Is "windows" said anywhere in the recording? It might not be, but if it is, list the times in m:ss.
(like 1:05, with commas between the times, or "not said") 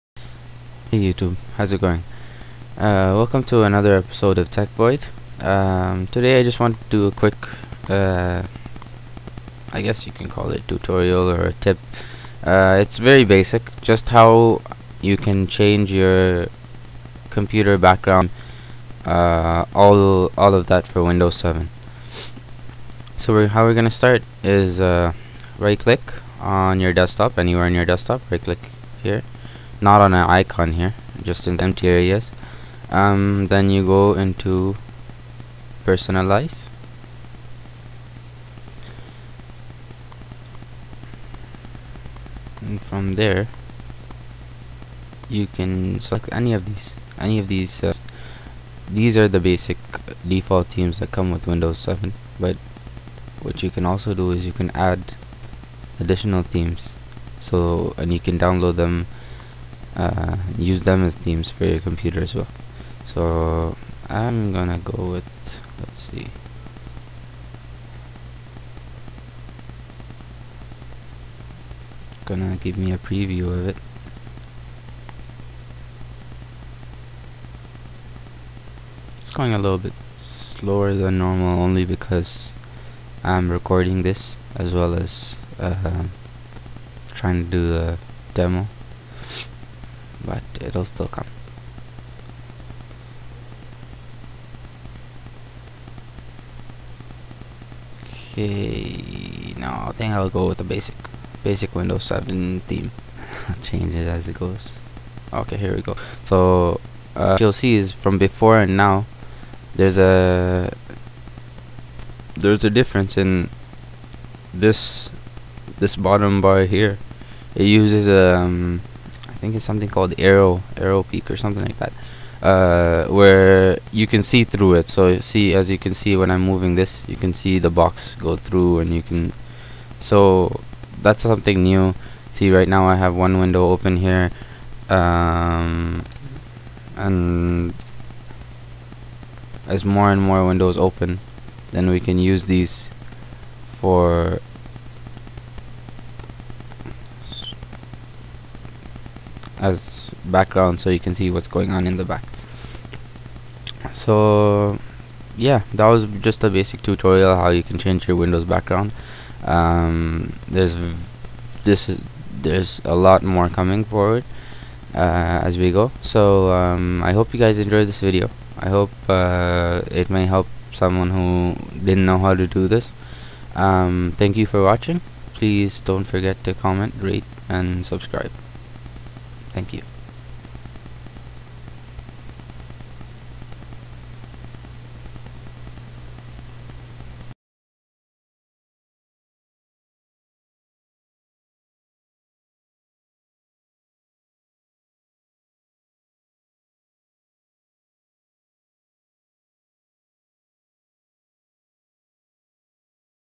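0:21, 0:51, 1:41, 2:13, 2:20, 2:38.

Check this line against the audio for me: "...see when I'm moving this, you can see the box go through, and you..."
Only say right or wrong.
right.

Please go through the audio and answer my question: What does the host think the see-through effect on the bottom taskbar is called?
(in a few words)
Aero Peek.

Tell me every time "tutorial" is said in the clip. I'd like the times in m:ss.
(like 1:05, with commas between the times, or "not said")
0:10, 2:36.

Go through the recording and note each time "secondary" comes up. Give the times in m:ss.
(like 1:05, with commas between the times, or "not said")
not said.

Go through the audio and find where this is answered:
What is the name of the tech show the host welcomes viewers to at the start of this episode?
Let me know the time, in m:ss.
0:04.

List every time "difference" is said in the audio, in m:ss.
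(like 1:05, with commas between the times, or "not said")
1:52.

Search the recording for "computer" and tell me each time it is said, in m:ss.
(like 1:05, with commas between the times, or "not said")
0:17, 1:01.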